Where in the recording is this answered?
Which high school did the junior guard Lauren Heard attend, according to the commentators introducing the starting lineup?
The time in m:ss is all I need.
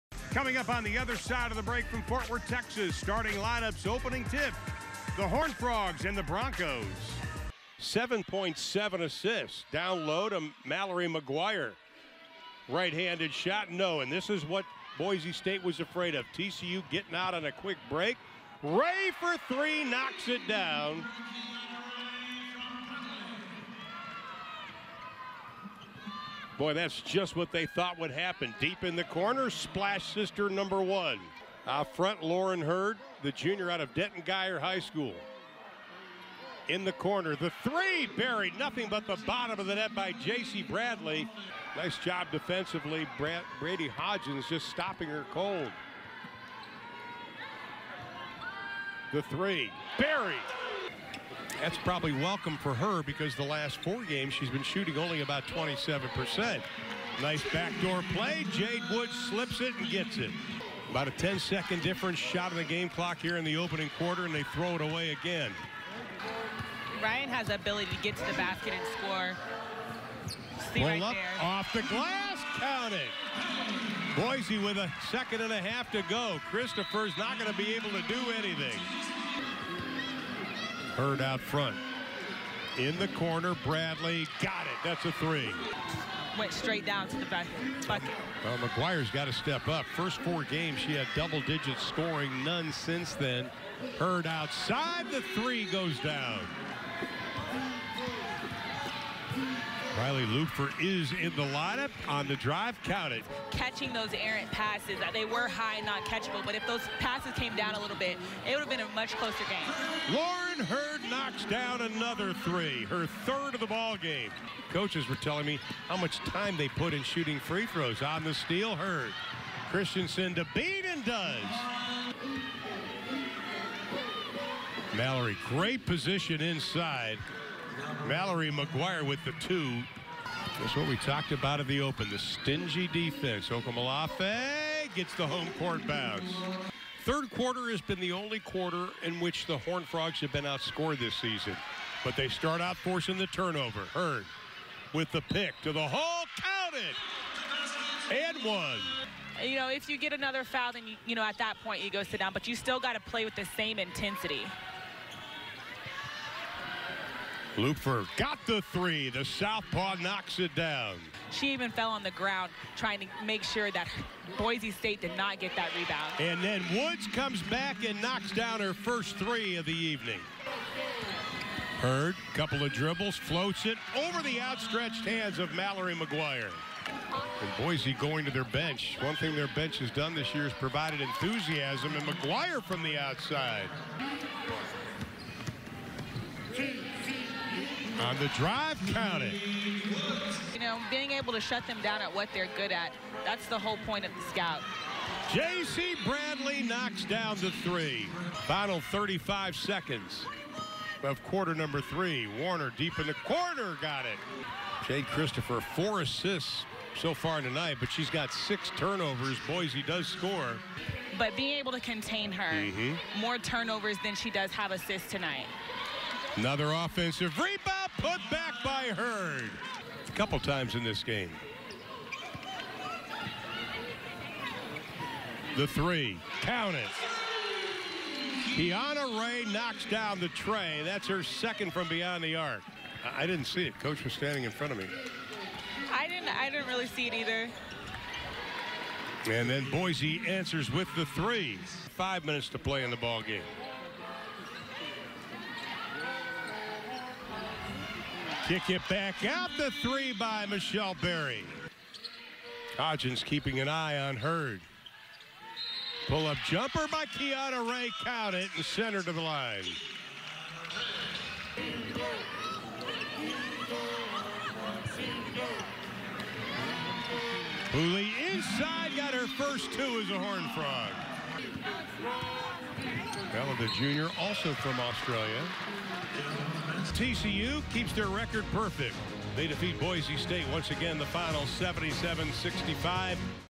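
0:33.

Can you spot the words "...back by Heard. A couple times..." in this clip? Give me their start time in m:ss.
3:38.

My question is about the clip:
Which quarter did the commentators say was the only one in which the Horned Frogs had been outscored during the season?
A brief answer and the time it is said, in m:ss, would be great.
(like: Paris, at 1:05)
Third quarter, at 2:17.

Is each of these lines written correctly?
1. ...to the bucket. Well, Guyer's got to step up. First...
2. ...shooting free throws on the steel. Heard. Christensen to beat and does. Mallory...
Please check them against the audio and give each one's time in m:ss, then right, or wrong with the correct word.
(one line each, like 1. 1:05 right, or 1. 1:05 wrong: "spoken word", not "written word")
1. 1:27 wrong: "McGwire", not "Guyer"
2. 1:57 right.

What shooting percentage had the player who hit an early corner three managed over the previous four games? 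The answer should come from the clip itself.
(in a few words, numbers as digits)
27%.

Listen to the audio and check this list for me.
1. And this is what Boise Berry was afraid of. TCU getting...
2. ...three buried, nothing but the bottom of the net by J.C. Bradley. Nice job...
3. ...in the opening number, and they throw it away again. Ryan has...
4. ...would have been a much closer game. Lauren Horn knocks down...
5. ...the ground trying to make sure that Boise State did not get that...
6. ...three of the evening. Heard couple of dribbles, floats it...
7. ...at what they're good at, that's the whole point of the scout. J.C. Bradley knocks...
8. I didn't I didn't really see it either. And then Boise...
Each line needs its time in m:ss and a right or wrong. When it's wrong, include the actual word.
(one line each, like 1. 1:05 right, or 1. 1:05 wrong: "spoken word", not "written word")
1. 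0:13 wrong: "State", not "Berry"
2. 0:37 right
3. 1:03 wrong: "quarter", not "number"
4. 1:48 wrong: "Heard", not "Horn"
5. 2:42 right
6. 2:49 right
7. 3:12 right
8. 3:55 right.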